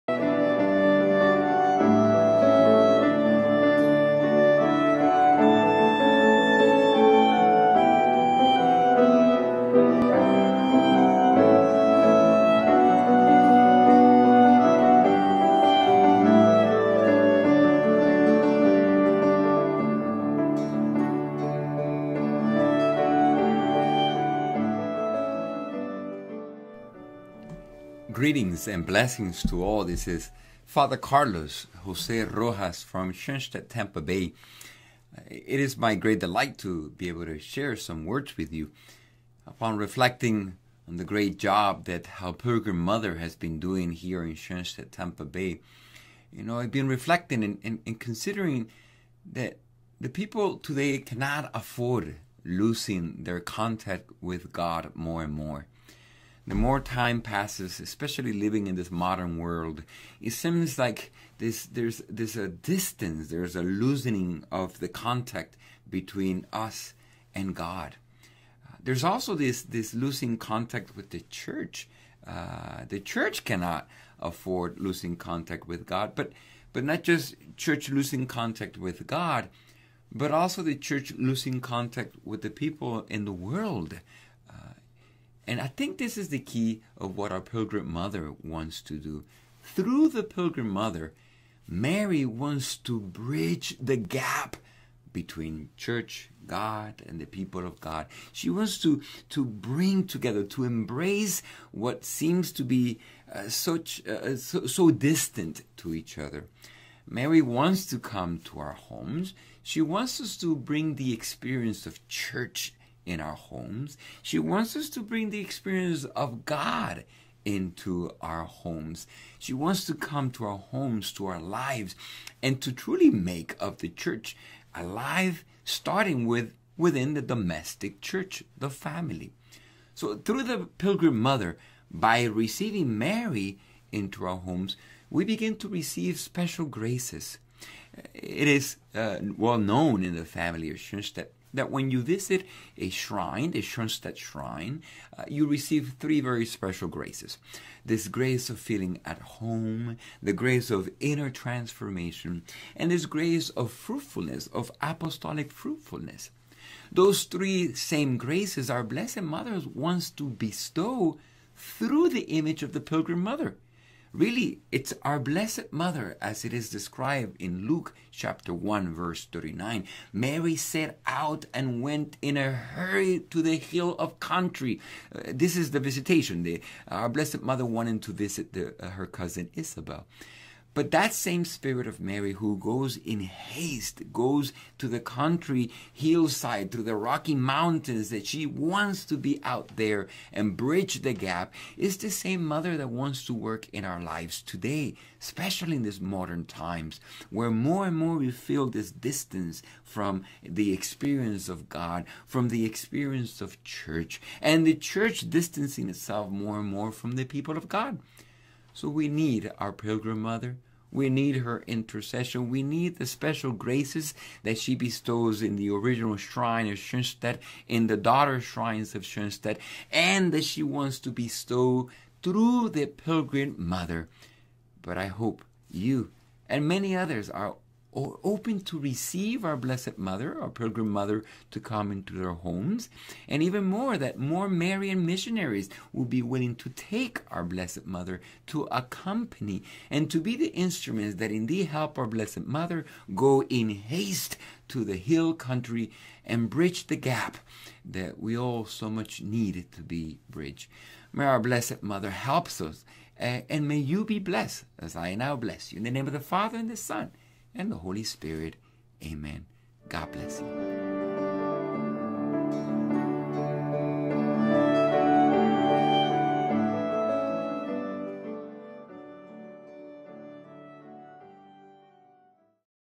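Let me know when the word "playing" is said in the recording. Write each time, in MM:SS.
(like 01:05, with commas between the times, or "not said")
not said.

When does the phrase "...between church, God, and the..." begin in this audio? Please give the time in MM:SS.
01:35.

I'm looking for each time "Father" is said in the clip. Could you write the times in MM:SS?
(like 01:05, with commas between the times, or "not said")
00:30, 04:16.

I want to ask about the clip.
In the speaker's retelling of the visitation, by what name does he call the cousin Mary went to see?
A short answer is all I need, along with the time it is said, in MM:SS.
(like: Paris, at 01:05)
Isabel, at 02:59.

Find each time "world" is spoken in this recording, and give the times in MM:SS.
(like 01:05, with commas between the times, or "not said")
00:59, 01:23.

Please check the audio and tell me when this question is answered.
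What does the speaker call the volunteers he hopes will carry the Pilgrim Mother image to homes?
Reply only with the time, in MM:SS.
03:54.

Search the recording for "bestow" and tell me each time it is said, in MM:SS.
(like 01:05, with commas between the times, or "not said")
02:40, 03:34, 03:41.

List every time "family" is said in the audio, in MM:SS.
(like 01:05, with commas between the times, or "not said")
02:08, 02:20.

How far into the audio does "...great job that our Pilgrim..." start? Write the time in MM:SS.
00:41.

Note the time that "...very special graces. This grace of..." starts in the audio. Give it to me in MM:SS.
02:26.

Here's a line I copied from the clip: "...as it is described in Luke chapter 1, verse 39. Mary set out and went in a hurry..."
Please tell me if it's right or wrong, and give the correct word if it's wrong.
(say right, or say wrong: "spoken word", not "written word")
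right.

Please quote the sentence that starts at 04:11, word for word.
May our Blessed Mother help us.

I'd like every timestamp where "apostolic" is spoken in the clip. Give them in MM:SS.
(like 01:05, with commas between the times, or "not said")
02:34.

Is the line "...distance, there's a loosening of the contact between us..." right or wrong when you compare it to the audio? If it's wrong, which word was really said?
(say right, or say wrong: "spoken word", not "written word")
right.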